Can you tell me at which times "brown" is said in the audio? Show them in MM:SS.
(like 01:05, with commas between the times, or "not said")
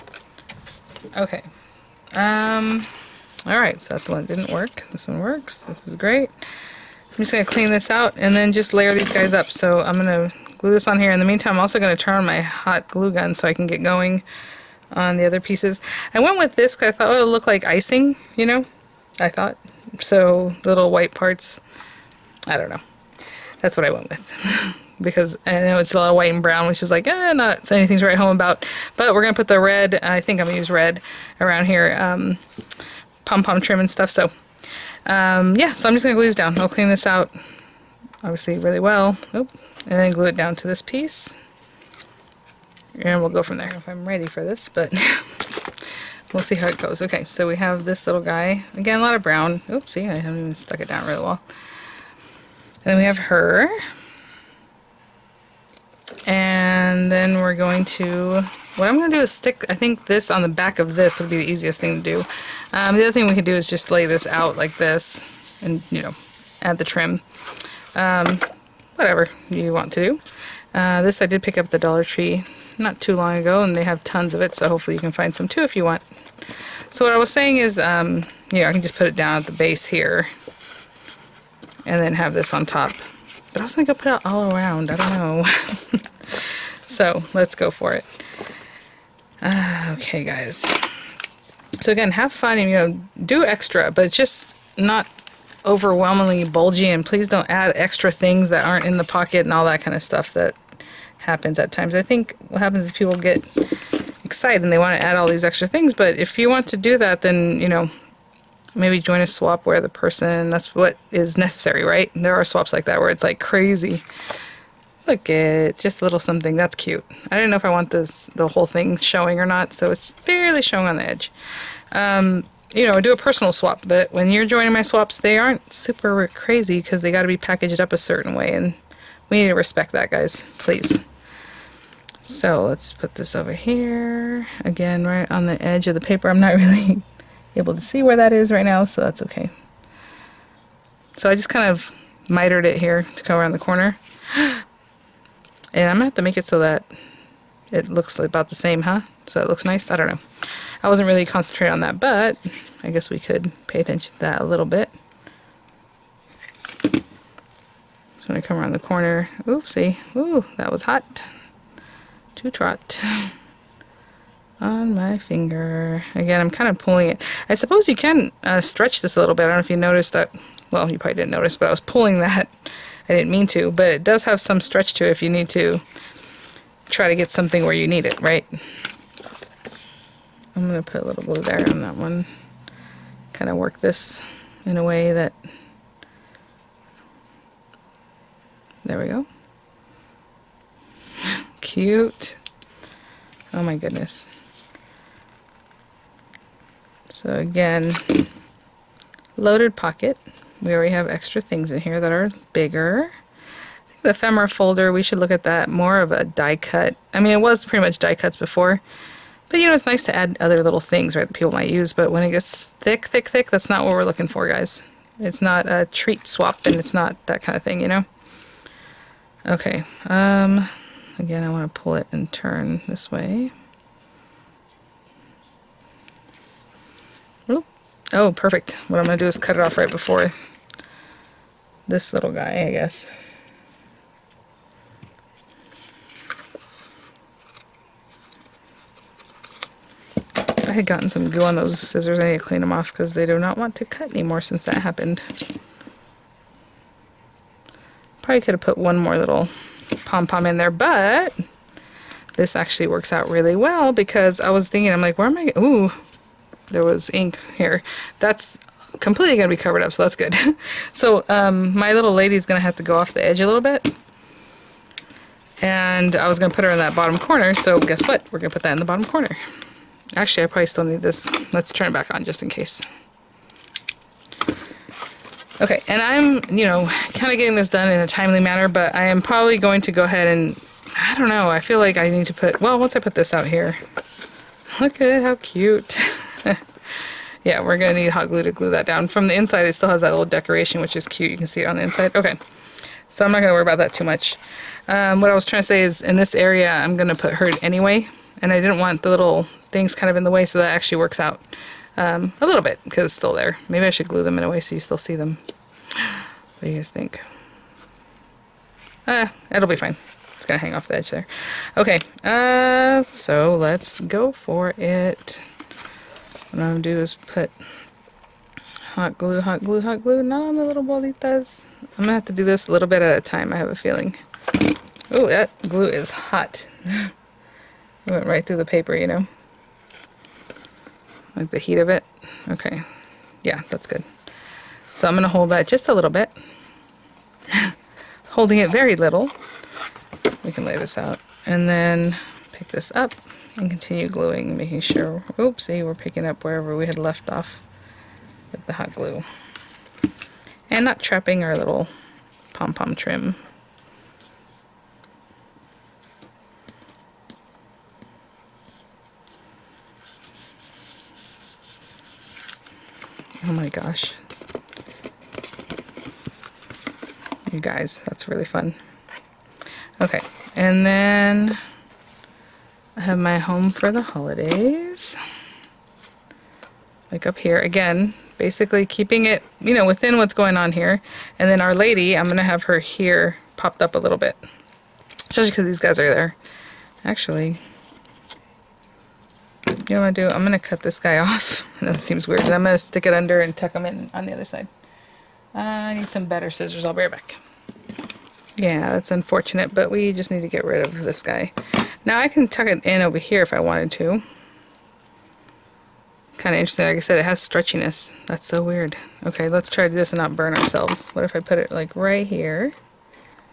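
00:26, 00:49.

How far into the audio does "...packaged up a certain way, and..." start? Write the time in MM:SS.
02:07.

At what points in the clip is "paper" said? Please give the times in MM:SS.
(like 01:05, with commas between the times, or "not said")
02:16, 05:28.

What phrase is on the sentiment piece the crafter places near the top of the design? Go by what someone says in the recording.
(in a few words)
Home for the holidays.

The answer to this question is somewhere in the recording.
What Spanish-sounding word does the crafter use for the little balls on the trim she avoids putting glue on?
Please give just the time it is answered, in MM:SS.
05:20.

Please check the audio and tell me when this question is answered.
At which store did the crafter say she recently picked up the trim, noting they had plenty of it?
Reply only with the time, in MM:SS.
01:11.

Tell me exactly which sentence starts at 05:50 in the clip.
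And not trapping our little pom-pom trim.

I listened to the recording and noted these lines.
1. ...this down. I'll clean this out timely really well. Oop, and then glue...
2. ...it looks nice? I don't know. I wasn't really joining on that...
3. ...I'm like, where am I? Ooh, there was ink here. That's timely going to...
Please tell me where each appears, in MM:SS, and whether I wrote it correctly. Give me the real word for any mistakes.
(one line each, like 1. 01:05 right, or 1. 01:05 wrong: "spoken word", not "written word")
1. 00:36 wrong: "obviously", not "timely"
2. 02:29 wrong: "concentrating", not "joining"
3. 04:14 wrong: "completely", not "timely".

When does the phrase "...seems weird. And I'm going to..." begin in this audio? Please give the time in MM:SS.
06:32.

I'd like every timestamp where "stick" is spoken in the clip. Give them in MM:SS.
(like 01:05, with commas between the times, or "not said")
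00:59, 06:32.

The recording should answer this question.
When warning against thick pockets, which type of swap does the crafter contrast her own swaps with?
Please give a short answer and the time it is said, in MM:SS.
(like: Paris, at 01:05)
Treat swap, at 03:35.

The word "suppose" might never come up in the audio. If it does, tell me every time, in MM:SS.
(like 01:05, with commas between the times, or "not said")
02:47.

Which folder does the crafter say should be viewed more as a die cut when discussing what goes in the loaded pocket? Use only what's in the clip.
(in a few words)
Ephemera folder.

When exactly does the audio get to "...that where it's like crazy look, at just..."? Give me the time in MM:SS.
01:52.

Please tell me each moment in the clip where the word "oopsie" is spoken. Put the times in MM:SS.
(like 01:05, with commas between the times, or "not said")
00:49, 02:39, 05:45.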